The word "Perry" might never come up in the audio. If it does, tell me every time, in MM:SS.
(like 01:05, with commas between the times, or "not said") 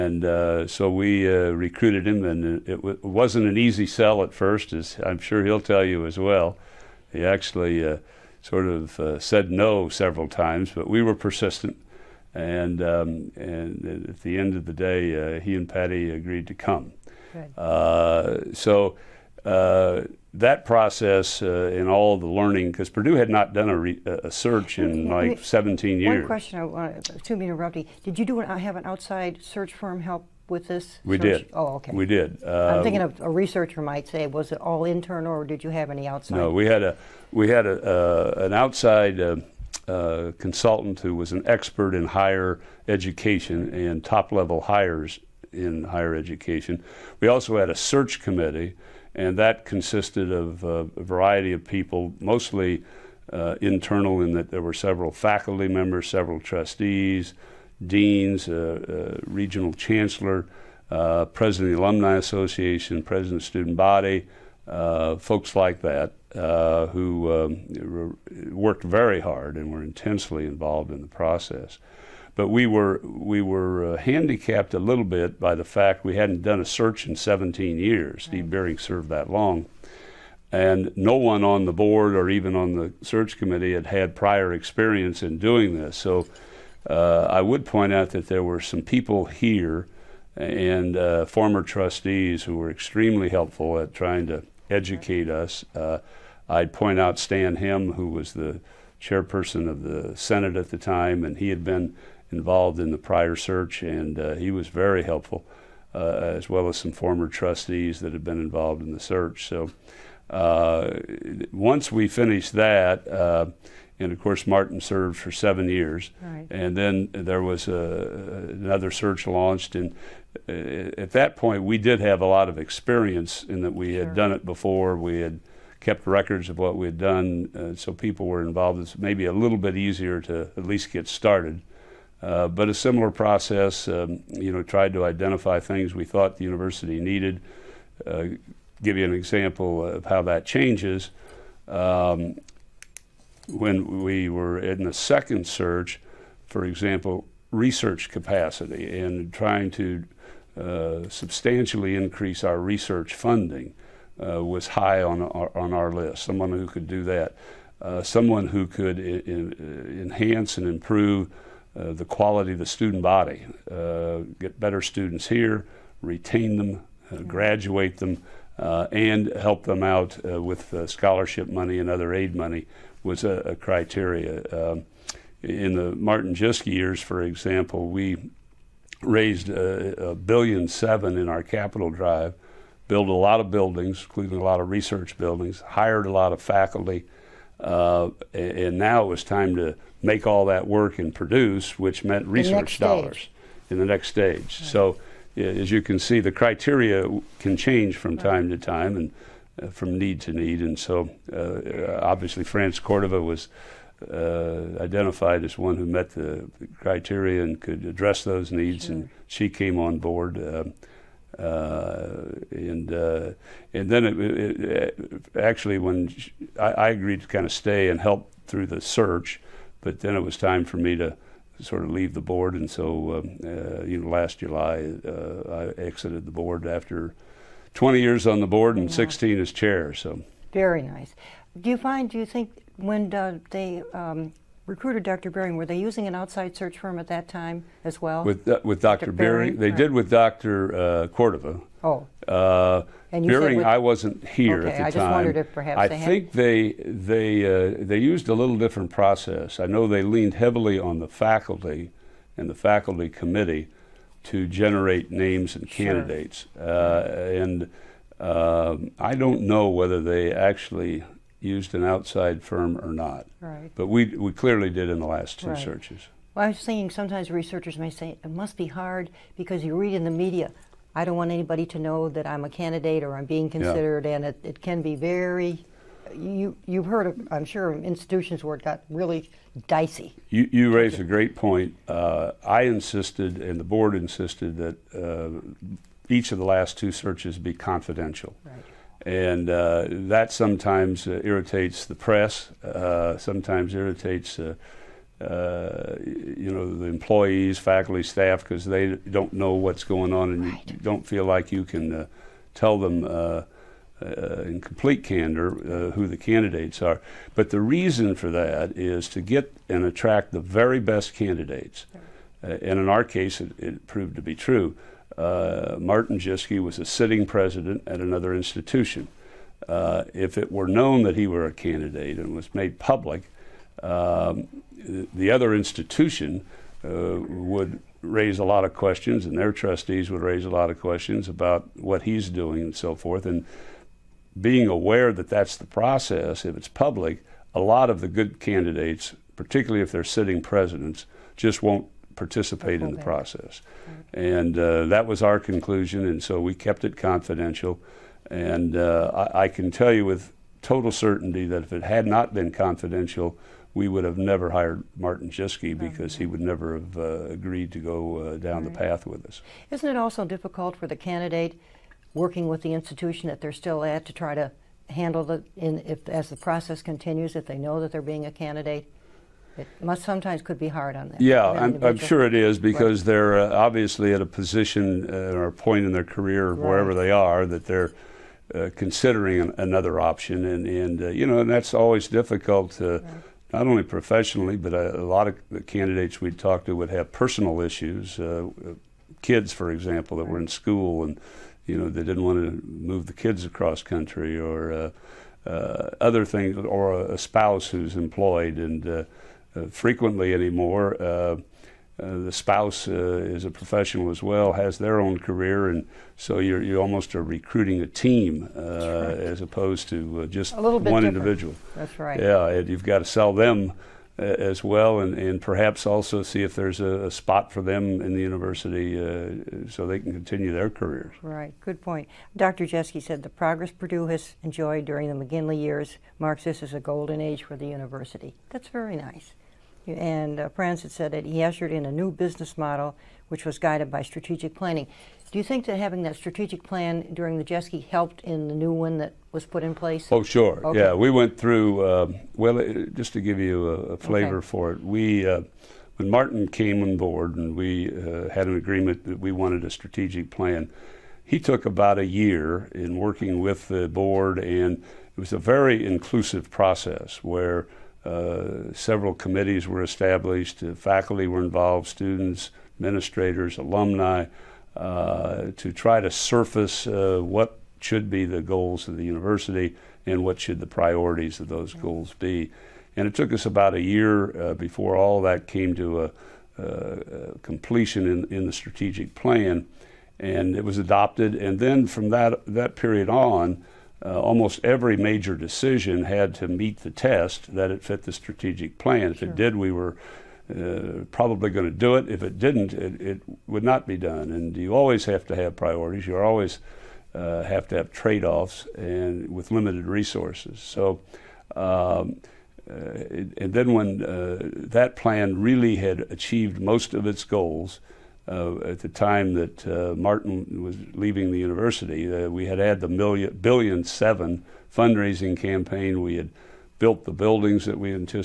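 not said.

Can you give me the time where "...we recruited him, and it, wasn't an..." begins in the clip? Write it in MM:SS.
00:00.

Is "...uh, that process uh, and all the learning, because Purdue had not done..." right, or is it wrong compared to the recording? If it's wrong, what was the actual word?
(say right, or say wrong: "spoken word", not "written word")
right.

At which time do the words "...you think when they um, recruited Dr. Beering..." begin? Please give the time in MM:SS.
03:52.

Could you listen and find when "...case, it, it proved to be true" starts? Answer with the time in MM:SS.
05:13.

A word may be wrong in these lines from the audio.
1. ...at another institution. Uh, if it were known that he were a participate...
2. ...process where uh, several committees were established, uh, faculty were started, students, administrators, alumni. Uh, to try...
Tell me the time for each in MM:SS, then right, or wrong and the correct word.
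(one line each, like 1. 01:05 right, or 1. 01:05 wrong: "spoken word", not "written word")
1. 05:17 wrong: "candidate", not "participate"
2. 07:36 wrong: "involved", not "started".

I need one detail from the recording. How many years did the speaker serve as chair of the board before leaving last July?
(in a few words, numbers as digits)
16.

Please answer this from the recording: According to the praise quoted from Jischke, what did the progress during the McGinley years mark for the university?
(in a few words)
a golden age.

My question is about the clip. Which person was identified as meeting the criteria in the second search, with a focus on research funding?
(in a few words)
France Cordova.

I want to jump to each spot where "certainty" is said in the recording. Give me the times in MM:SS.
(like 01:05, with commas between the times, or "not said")
05:50.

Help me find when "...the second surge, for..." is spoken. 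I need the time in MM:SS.
02:24.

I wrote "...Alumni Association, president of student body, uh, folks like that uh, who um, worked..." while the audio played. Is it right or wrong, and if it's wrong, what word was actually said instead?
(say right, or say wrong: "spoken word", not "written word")
right.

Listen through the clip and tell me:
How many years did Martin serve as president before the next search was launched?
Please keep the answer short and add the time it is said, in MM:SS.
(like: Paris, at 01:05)
7, at 01:55.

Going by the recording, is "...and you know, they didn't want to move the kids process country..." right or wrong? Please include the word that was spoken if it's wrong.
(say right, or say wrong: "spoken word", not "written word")
wrong: "across", not "process".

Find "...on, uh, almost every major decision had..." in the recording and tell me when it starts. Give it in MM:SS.
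08:03.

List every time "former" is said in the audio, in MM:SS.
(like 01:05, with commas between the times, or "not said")
01:31, 01:46.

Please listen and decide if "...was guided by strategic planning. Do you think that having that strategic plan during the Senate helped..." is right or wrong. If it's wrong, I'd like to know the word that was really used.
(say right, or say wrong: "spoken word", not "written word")
wrong: "Jischke", not "Senate".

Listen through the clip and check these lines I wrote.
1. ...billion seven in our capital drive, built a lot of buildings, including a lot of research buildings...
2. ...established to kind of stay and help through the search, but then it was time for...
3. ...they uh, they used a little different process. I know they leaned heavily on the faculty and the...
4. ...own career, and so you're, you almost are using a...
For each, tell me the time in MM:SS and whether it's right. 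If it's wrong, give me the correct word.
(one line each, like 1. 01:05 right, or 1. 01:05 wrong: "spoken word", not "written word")
1. 03:00 right
2. 03:36 wrong: "agreed", not "established"
3. 04:06 right
4. 06:44 wrong: "recruiting", not "using".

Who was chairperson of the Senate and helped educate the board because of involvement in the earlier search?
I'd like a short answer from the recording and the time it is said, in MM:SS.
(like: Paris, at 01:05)
Stan Him, at 01:37.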